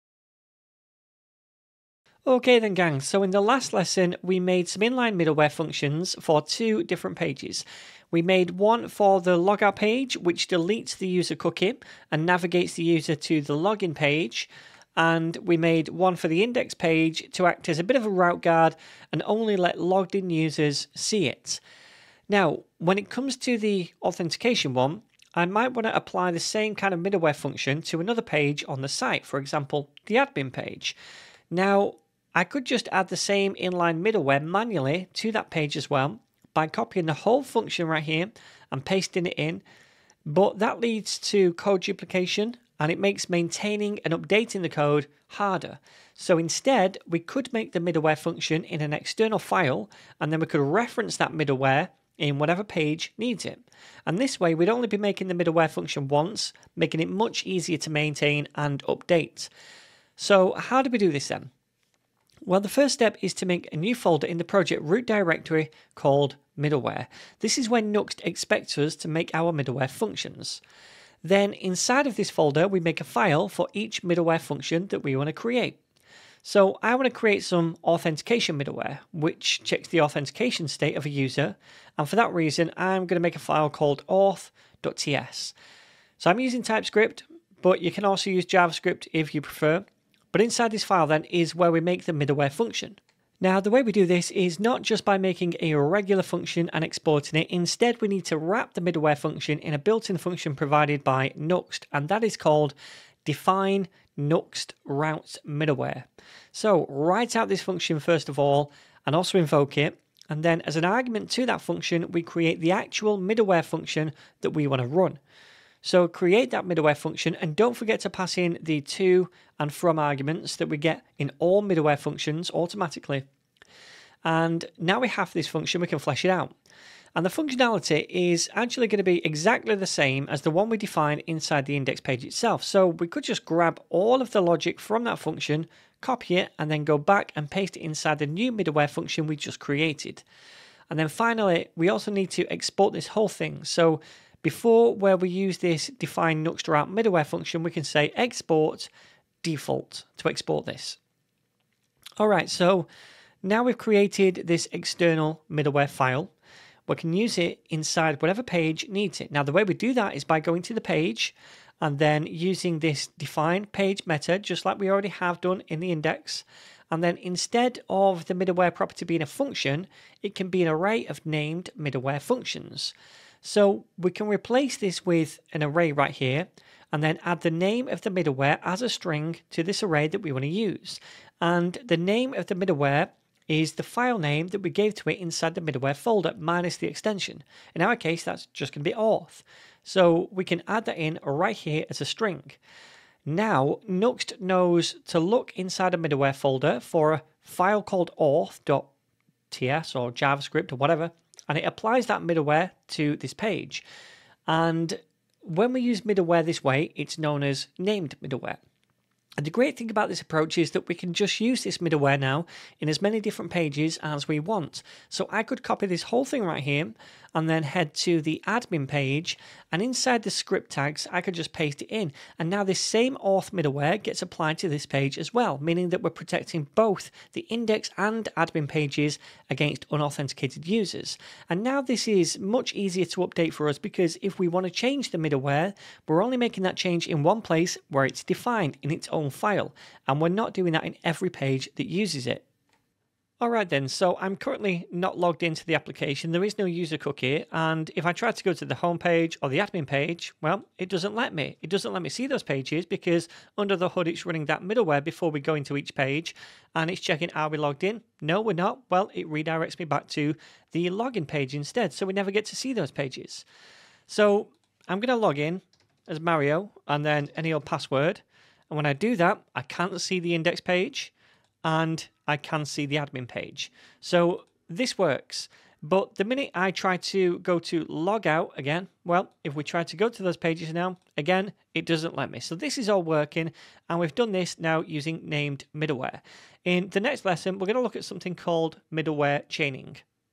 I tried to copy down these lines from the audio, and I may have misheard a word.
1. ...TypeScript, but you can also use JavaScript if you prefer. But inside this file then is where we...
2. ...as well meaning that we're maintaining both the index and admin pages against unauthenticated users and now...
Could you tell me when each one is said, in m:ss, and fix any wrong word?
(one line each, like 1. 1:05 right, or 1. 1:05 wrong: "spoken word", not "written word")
1. 1:26 right
2. 3:45 wrong: "protecting", not "maintaining".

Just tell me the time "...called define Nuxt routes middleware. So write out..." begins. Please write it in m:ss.
1:42.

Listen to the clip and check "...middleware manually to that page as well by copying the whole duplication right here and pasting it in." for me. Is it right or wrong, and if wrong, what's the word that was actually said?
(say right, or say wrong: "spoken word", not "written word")
wrong: "function", not "duplication".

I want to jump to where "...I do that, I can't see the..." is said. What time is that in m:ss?
4:28.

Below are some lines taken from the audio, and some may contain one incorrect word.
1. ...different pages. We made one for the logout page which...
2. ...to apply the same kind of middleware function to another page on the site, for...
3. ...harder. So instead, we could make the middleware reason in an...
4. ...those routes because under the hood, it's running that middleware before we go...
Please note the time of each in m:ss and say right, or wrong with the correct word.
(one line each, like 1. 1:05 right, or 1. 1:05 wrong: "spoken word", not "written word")
1. 0:06 right
2. 0:25 right
3. 0:45 wrong: "function", not "reason"
4. 4:12 wrong: "pages", not "routes".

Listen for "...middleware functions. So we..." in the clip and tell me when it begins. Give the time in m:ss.
2:51.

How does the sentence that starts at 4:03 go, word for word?
All right then, so I'm currently not logged into the application.